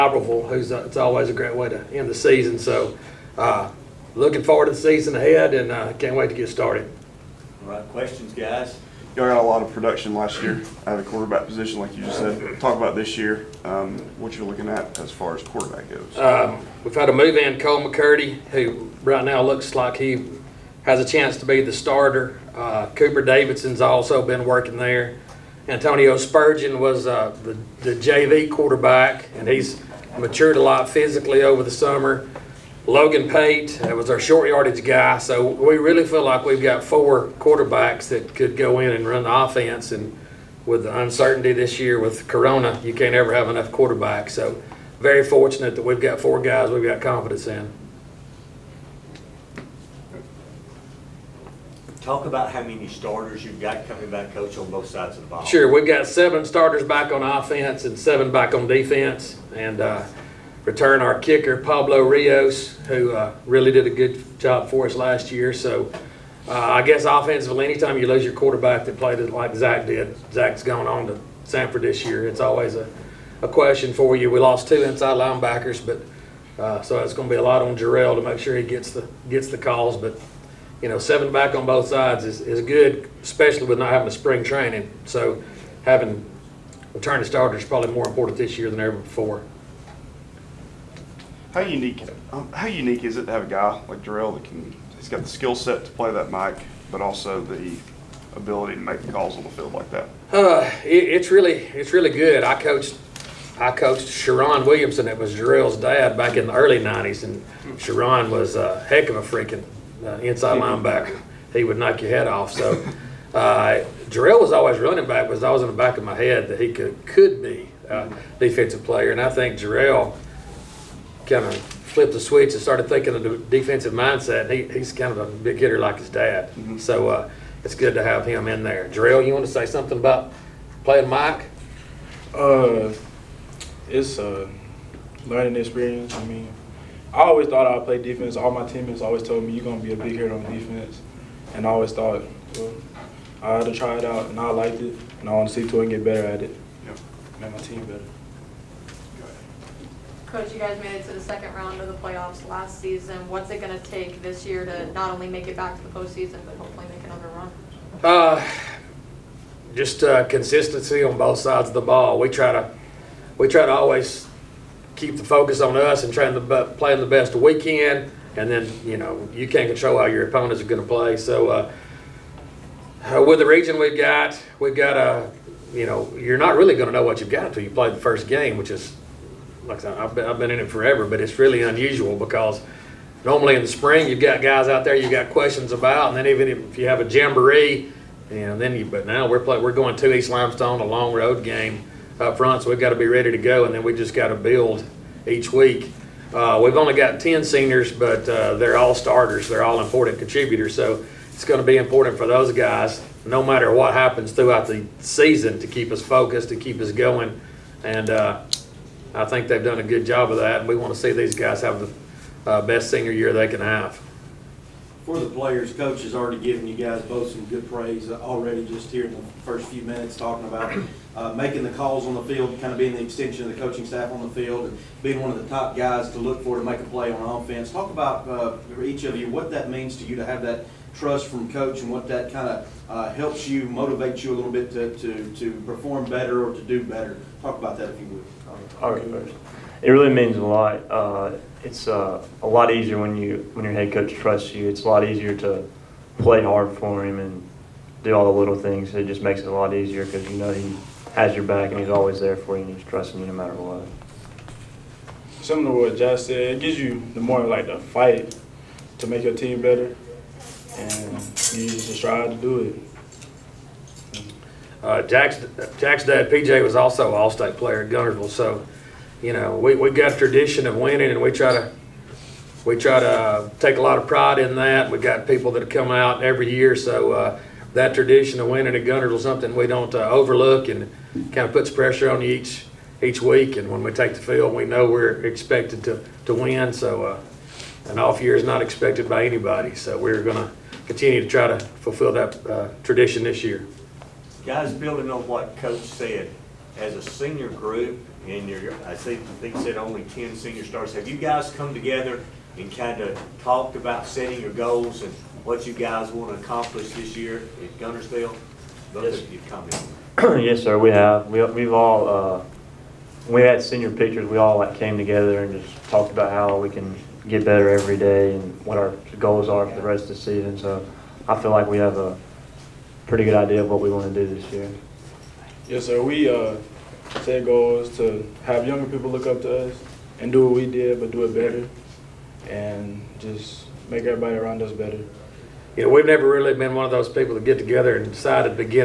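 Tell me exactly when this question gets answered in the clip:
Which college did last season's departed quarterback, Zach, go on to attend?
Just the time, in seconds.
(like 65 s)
71 s.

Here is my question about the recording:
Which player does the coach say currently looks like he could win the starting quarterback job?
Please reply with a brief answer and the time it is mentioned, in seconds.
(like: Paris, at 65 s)
Cole McCurdy, at 17 s.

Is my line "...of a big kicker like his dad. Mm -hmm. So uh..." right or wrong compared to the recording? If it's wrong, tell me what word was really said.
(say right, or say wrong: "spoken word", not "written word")
wrong: "hitter", not "kicker".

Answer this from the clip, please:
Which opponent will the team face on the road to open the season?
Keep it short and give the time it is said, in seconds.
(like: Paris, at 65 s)
East Limestone, at 190 s.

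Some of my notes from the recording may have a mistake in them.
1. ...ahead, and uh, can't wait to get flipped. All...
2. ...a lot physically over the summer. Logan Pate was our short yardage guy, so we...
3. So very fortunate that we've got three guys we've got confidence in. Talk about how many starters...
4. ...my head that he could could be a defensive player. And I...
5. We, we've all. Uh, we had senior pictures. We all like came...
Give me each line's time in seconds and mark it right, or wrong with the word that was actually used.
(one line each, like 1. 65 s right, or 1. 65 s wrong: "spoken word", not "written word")
1. 5 s wrong: "started", not "flipped"
2. 30 s right
3. 44 s wrong: "four", not "three"
4. 116 s right
5. 311 s right.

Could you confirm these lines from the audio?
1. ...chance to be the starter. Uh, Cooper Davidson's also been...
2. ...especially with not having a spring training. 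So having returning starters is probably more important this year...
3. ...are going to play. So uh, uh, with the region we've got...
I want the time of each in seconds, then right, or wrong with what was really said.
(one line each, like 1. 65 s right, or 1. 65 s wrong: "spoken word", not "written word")
1. 21 s right
2. 83 s right
3. 170 s right.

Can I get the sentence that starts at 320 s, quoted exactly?
So I feel like we have a pretty good idea of what we want to do this year.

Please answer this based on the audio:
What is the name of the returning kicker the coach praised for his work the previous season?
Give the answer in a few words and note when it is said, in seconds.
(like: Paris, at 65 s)
Pablo Rios, at 61 s.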